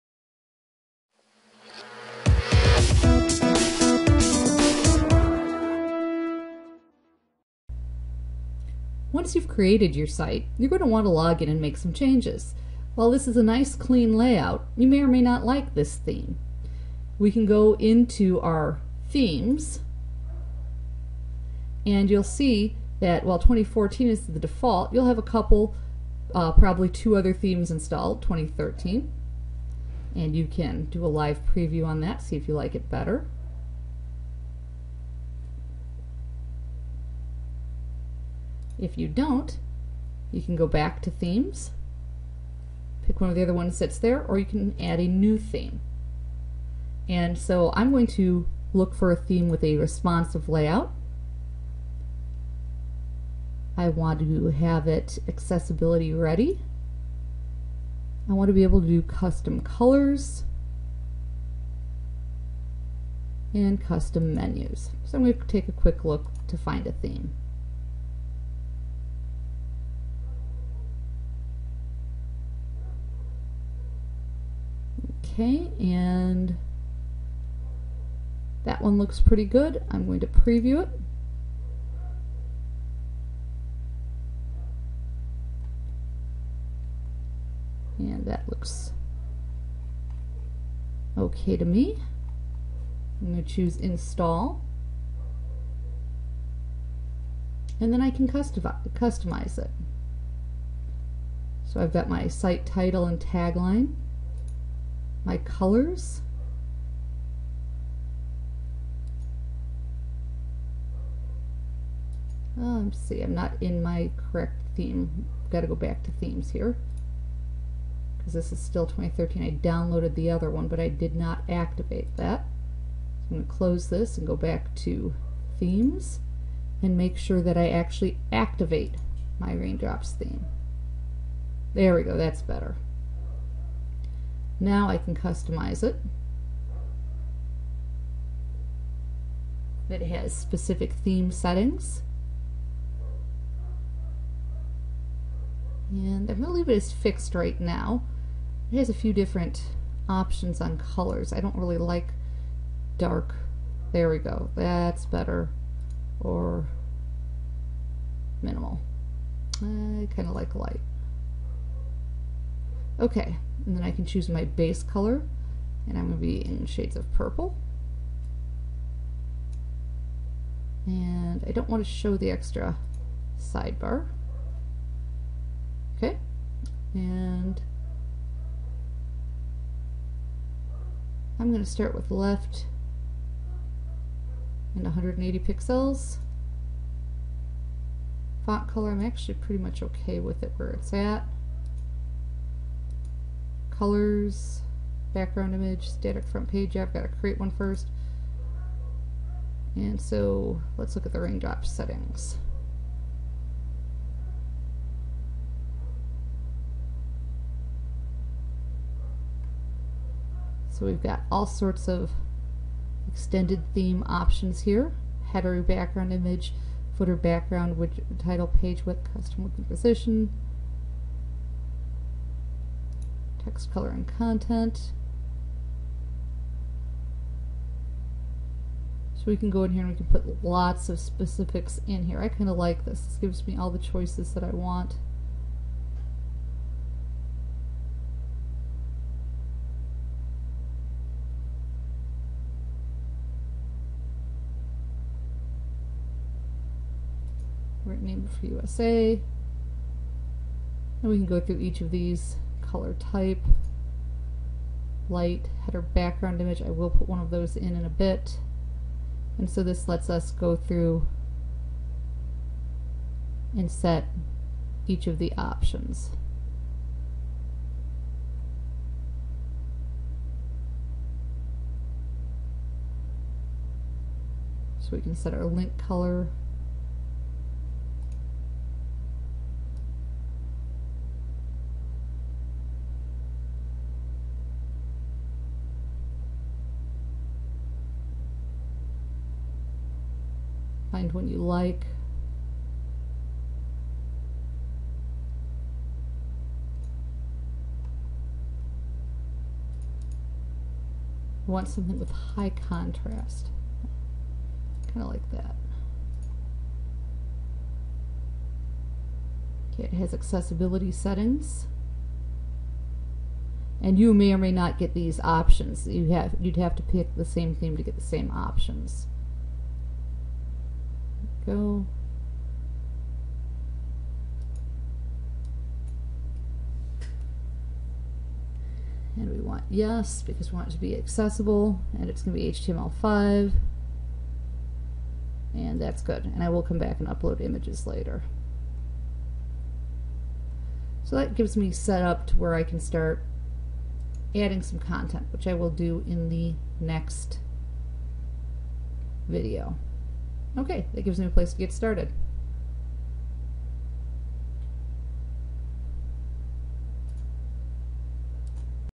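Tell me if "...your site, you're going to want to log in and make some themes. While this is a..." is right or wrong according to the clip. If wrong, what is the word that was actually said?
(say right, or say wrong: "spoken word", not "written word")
wrong: "changes", not "themes".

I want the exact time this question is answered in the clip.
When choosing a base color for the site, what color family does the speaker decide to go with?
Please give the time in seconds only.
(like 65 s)
167 s.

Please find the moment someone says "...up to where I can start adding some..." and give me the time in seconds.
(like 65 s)
342 s.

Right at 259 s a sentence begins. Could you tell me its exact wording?
And so this lets us go through and set each of the options.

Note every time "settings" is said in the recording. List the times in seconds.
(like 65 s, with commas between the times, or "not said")
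141 s, 201 s, 310 s.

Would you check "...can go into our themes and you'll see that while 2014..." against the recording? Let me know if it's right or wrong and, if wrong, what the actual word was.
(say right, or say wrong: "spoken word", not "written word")
right.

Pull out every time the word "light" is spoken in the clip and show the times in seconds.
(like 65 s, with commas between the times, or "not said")
160 s, 255 s.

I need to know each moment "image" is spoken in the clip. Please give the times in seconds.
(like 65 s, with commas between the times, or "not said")
195 s, 216 s, 256 s, 337 s.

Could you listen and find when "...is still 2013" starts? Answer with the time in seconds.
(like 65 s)
118 s.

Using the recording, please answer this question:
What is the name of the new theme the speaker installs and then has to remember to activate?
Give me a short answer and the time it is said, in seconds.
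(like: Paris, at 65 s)
Raindrops, at 129 s.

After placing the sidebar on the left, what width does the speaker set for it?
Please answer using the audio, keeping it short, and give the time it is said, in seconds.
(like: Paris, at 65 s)
180 pixels, at 184 s.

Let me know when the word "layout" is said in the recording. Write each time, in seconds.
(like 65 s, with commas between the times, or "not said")
14 s, 50 s.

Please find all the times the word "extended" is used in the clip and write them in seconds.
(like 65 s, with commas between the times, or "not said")
213 s.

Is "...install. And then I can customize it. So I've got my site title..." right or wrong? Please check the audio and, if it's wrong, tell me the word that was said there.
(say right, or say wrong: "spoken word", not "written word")
right.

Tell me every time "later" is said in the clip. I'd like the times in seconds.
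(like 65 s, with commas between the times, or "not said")
337 s.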